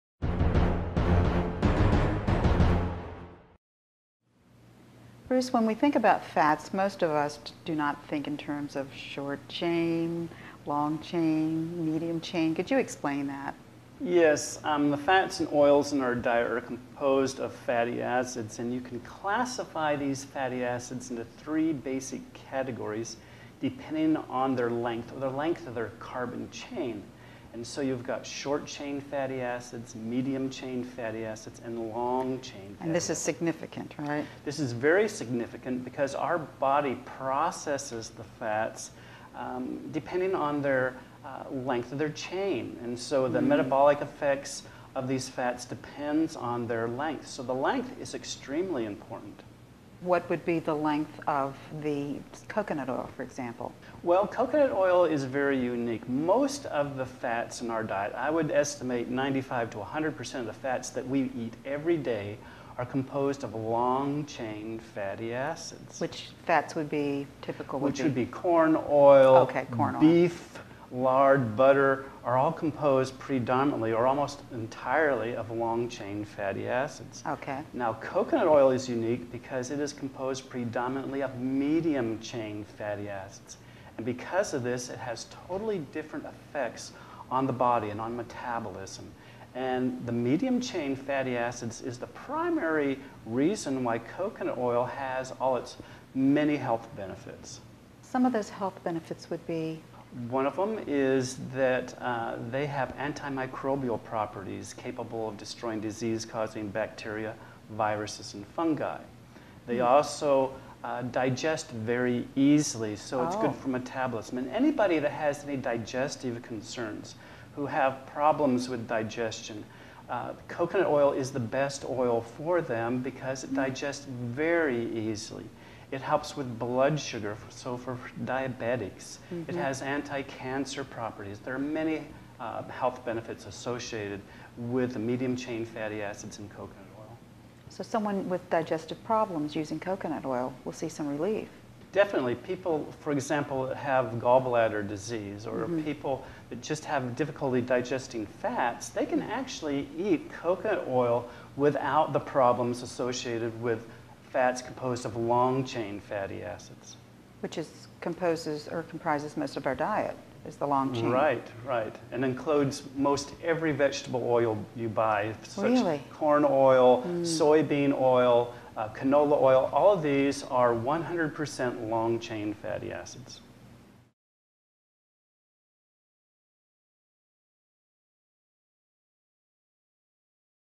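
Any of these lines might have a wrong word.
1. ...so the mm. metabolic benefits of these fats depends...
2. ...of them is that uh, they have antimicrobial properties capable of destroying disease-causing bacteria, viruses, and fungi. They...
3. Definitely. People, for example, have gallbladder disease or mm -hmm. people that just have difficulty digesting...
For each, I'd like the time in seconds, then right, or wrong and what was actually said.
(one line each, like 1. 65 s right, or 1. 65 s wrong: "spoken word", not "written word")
1. 42 s wrong: "effects", not "benefits"
2. 100 s right
3. 141 s right.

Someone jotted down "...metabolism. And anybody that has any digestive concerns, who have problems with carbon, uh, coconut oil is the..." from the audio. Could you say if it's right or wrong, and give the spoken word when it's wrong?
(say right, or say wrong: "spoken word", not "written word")
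wrong: "digestion", not "carbon".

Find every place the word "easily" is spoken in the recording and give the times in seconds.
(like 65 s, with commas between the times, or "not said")
112 s, 124 s.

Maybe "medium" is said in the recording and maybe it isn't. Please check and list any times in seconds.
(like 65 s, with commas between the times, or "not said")
11 s, 29 s, 81 s, 90 s, 134 s.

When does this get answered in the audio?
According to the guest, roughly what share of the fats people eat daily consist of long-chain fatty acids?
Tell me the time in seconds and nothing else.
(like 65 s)
59 s.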